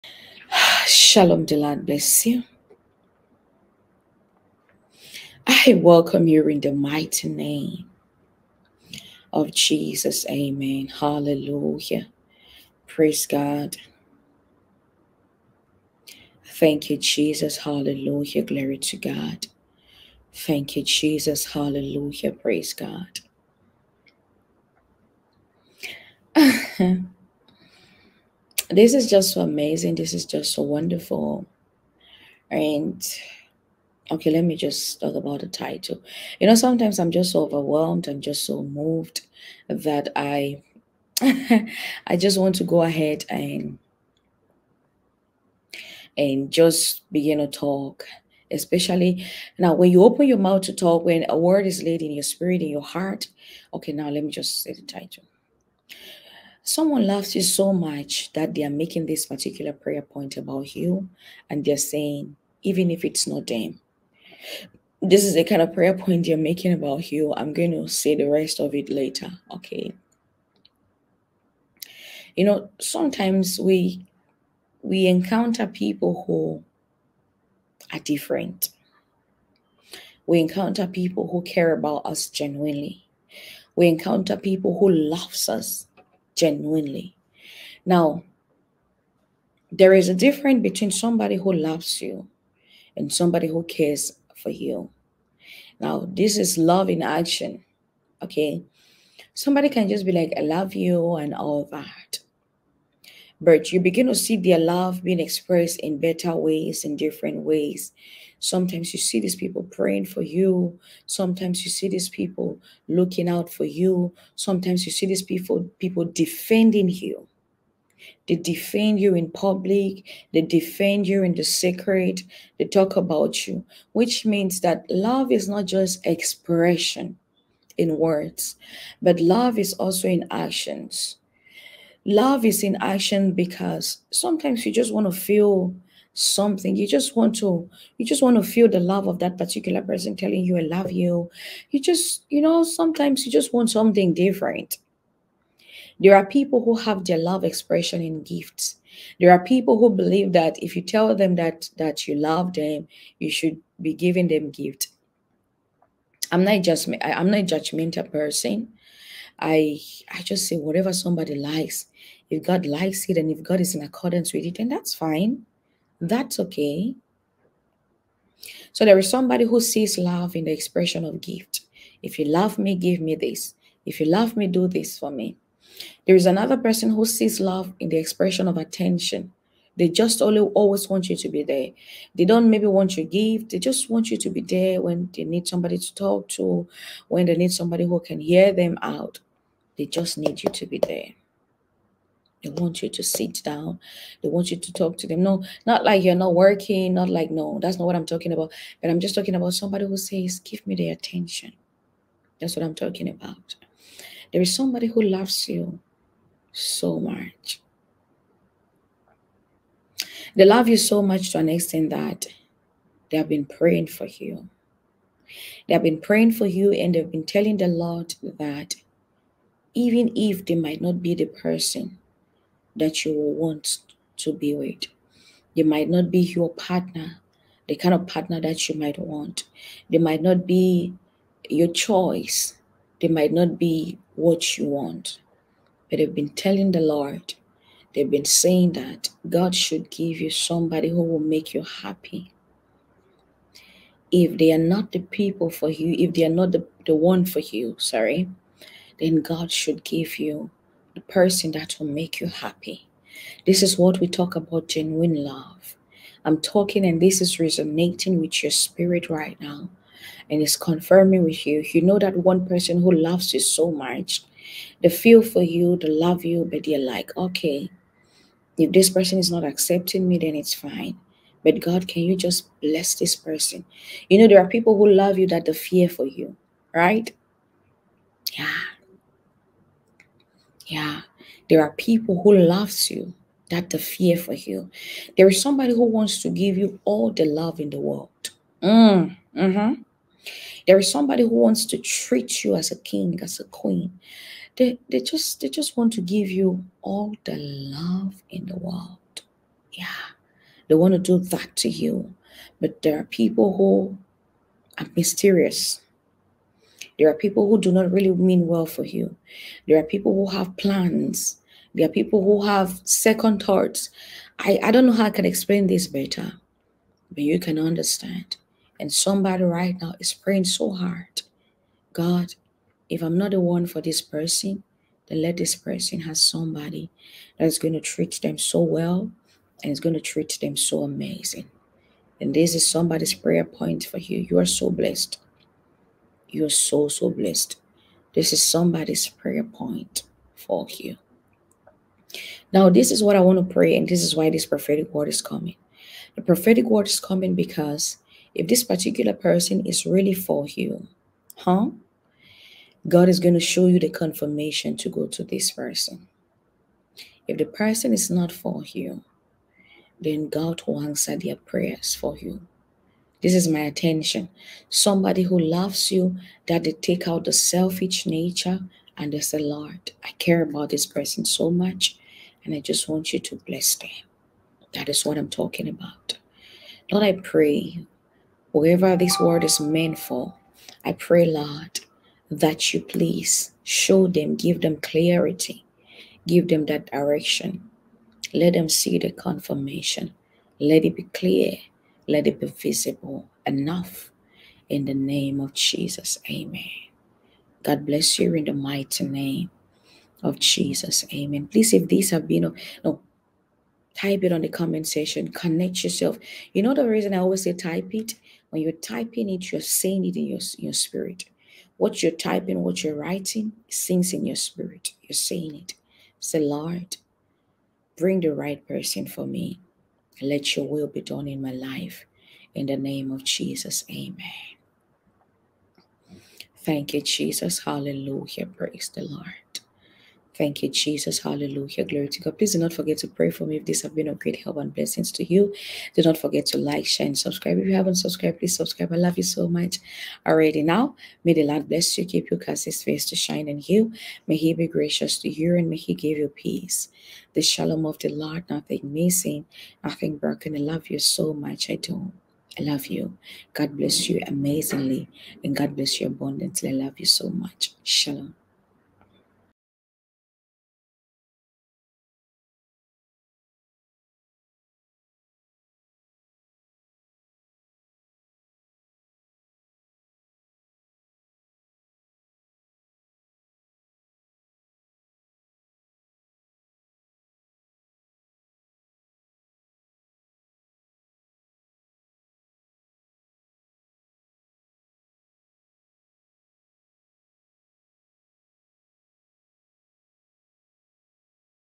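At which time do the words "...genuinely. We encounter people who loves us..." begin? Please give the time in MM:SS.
01:22.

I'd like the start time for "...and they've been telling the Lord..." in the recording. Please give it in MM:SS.
03:36.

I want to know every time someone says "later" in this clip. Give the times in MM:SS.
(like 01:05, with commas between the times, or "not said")
01:08.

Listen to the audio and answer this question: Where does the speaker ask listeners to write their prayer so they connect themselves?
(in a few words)
Comment section.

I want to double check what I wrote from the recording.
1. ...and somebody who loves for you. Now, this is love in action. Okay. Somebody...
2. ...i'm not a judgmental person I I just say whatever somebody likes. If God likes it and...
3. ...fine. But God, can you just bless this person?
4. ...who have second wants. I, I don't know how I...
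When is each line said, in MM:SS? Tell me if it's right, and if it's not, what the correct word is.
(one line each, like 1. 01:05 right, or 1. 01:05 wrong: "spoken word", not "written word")
1. 01:32 wrong: "cares", not "loves"
2. 02:37 right
3. 04:30 right
4. 05:12 wrong: "thoughts", not "wants".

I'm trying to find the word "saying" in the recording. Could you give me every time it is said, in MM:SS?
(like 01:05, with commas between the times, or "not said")
01:01, 03:58, 06:49, 06:55.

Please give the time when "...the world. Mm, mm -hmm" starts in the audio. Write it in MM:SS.
04:47.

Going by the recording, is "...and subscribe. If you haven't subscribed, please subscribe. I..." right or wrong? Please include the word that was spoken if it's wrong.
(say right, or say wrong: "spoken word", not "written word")
right.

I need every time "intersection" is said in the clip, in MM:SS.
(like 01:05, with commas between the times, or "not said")
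not said.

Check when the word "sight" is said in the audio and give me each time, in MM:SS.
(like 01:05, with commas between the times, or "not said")
not said.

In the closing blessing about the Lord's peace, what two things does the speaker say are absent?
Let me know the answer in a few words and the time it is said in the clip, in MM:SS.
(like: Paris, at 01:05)
Nothing missing, nothing broken, at 07:28.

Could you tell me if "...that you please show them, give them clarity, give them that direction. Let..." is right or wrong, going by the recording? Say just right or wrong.
right.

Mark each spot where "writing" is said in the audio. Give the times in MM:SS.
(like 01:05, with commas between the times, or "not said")
06:52.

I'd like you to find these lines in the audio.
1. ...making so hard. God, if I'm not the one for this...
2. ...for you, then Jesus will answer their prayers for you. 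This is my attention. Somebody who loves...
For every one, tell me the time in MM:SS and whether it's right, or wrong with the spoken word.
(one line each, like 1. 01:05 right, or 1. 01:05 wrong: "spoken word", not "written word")
1. 05:20 wrong: "praying", not "making"
2. 05:58 wrong: "God", not "Jesus".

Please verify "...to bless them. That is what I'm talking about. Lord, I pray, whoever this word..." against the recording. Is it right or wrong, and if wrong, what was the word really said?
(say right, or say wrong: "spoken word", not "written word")
right.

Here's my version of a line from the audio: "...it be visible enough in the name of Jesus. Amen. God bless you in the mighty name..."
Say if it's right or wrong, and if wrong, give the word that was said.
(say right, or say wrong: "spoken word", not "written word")
right.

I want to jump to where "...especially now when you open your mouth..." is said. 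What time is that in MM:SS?
00:48.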